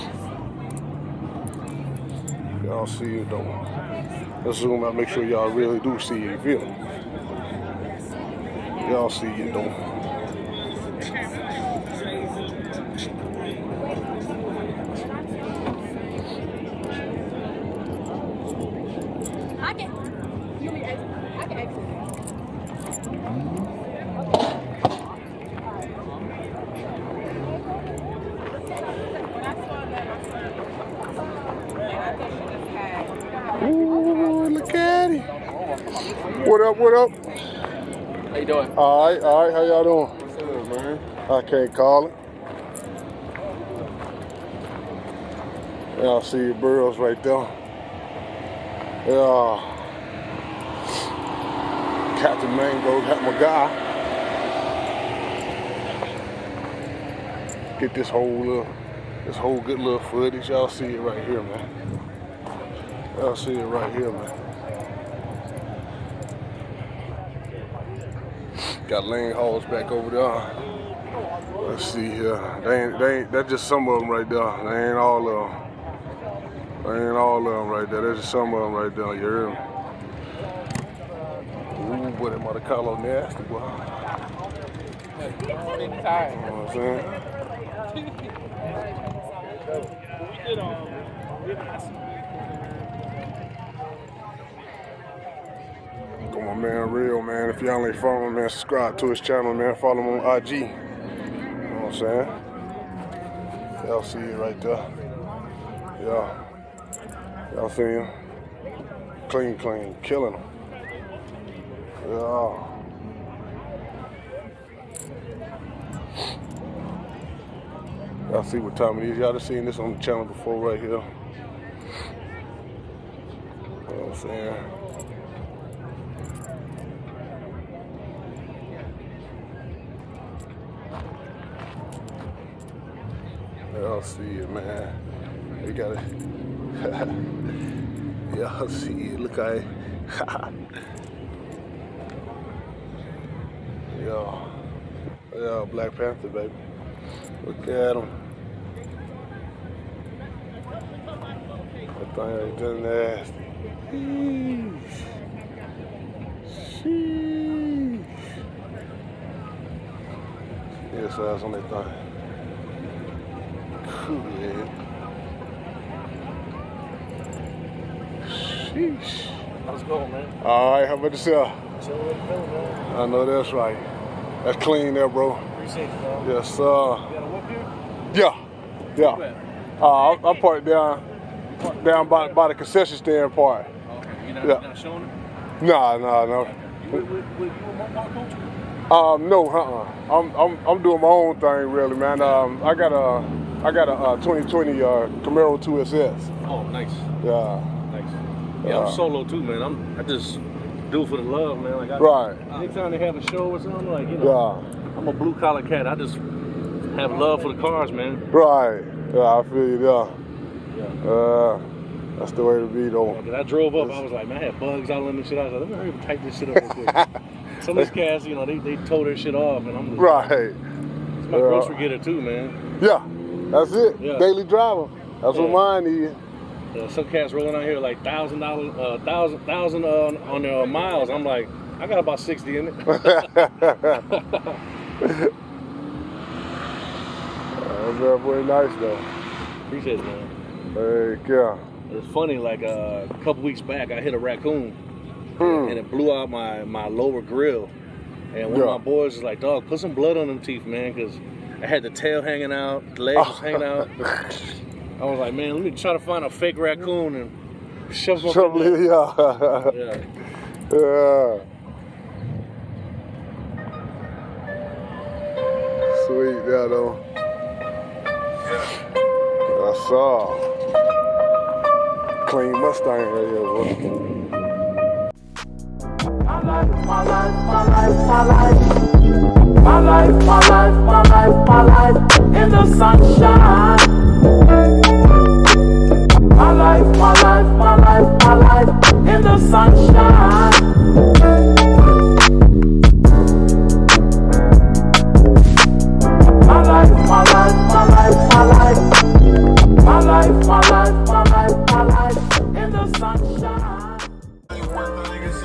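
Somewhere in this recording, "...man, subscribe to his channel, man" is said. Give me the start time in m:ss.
1:38.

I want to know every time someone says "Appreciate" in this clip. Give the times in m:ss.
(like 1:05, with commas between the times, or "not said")
2:55, 3:59.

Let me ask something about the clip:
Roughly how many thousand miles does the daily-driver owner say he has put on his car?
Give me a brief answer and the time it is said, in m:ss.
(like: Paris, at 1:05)
60, at 3:52.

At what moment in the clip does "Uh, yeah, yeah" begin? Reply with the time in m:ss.
2:56.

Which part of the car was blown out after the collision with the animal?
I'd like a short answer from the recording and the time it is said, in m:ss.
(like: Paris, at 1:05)
lower grill, at 4:06.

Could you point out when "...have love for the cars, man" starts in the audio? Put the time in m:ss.
3:26.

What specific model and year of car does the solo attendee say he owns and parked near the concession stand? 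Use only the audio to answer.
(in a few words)
2020 Camaro 2SS.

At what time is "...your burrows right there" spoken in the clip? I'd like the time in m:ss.
0:46.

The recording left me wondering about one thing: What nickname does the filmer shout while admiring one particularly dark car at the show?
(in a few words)
Black Panther.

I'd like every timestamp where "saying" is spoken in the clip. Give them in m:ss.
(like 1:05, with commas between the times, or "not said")
1:26, 1:41, 2:04.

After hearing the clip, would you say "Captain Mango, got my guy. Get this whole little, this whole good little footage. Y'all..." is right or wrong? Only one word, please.
right.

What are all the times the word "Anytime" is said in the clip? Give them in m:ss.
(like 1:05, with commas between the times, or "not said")
3:22.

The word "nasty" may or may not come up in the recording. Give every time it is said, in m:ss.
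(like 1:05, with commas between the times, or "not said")
1:23, 2:32.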